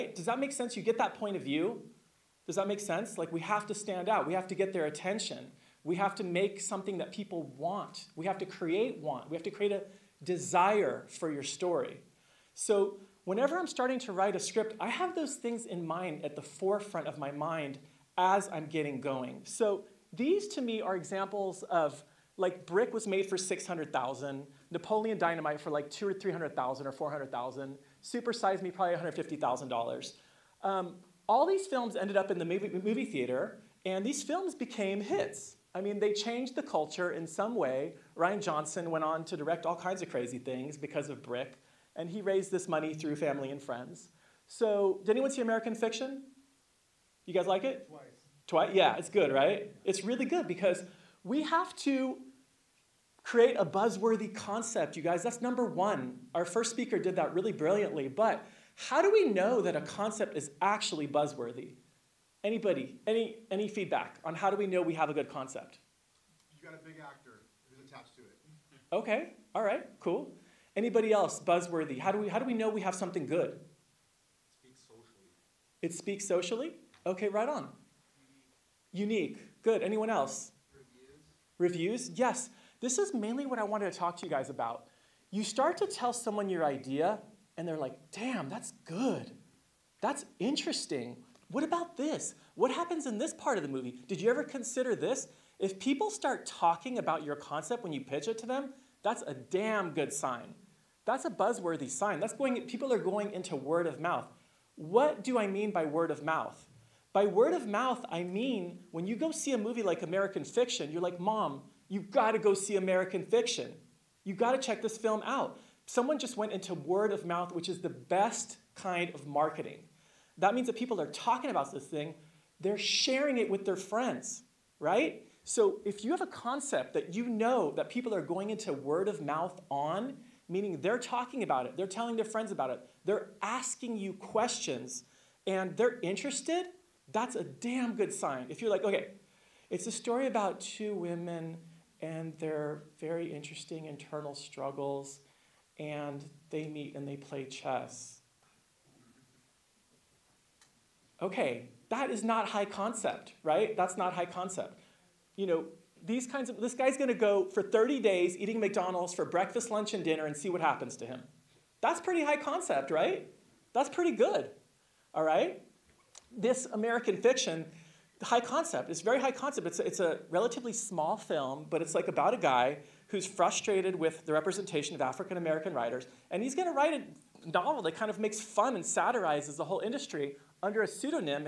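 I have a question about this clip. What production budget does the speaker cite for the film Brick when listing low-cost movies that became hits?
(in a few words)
600,000.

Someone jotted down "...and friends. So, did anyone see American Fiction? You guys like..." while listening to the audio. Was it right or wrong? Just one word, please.
right.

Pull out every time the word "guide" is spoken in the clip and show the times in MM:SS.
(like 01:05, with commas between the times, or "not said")
not said.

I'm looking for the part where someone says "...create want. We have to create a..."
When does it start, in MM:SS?
00:08.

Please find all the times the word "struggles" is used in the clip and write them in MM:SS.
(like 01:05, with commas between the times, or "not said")
02:24.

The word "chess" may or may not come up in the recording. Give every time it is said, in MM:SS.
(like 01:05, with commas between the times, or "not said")
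02:27.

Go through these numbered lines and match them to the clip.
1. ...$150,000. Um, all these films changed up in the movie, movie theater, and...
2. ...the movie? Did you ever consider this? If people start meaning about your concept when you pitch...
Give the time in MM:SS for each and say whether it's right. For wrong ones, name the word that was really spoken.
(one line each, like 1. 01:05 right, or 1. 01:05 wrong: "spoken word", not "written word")
1. 00:28 wrong: "ended", not "changed"
2. 01:33 wrong: "talking", not "meaning".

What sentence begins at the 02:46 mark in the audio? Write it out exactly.
This American fiction, high concept, it's very high concept.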